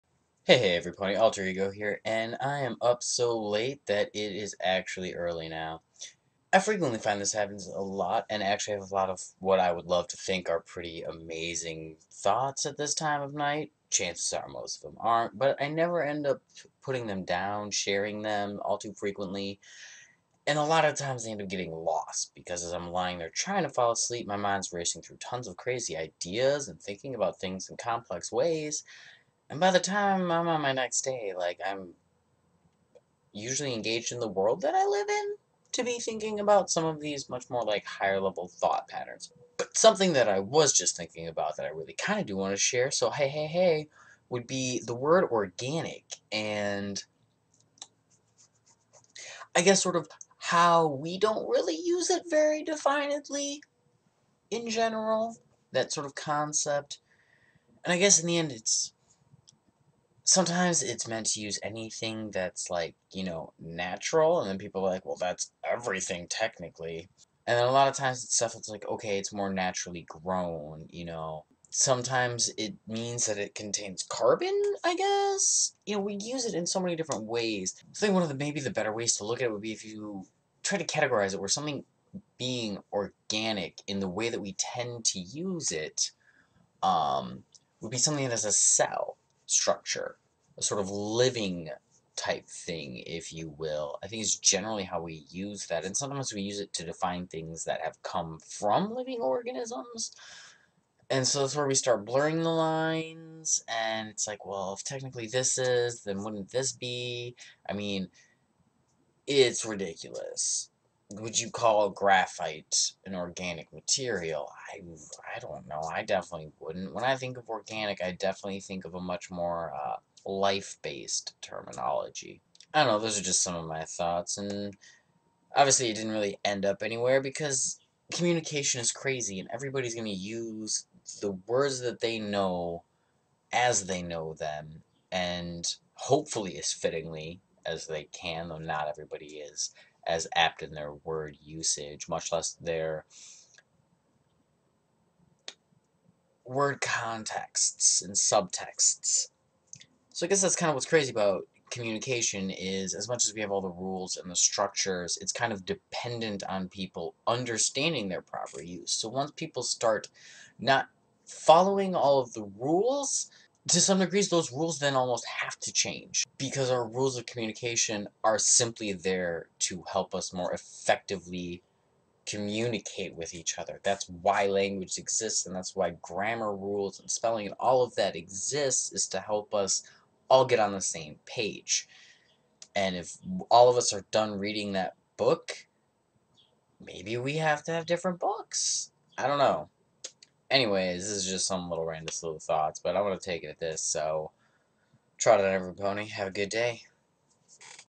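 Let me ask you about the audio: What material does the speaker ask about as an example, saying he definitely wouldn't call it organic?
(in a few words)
graphite.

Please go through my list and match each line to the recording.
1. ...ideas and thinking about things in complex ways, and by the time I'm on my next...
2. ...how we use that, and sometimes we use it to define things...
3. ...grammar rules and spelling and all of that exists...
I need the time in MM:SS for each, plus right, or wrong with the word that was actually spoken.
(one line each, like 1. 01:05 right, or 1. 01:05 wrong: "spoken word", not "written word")
1. 00:25 right
2. 01:34 right
3. 02:56 right.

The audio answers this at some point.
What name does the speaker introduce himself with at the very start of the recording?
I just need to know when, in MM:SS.
00:01.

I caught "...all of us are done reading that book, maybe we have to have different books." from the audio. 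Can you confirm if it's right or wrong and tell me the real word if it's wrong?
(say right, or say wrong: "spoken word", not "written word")
right.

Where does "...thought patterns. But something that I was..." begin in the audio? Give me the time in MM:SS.
00:38.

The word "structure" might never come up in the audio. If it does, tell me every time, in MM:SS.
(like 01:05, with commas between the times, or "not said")
01:29, 02:34.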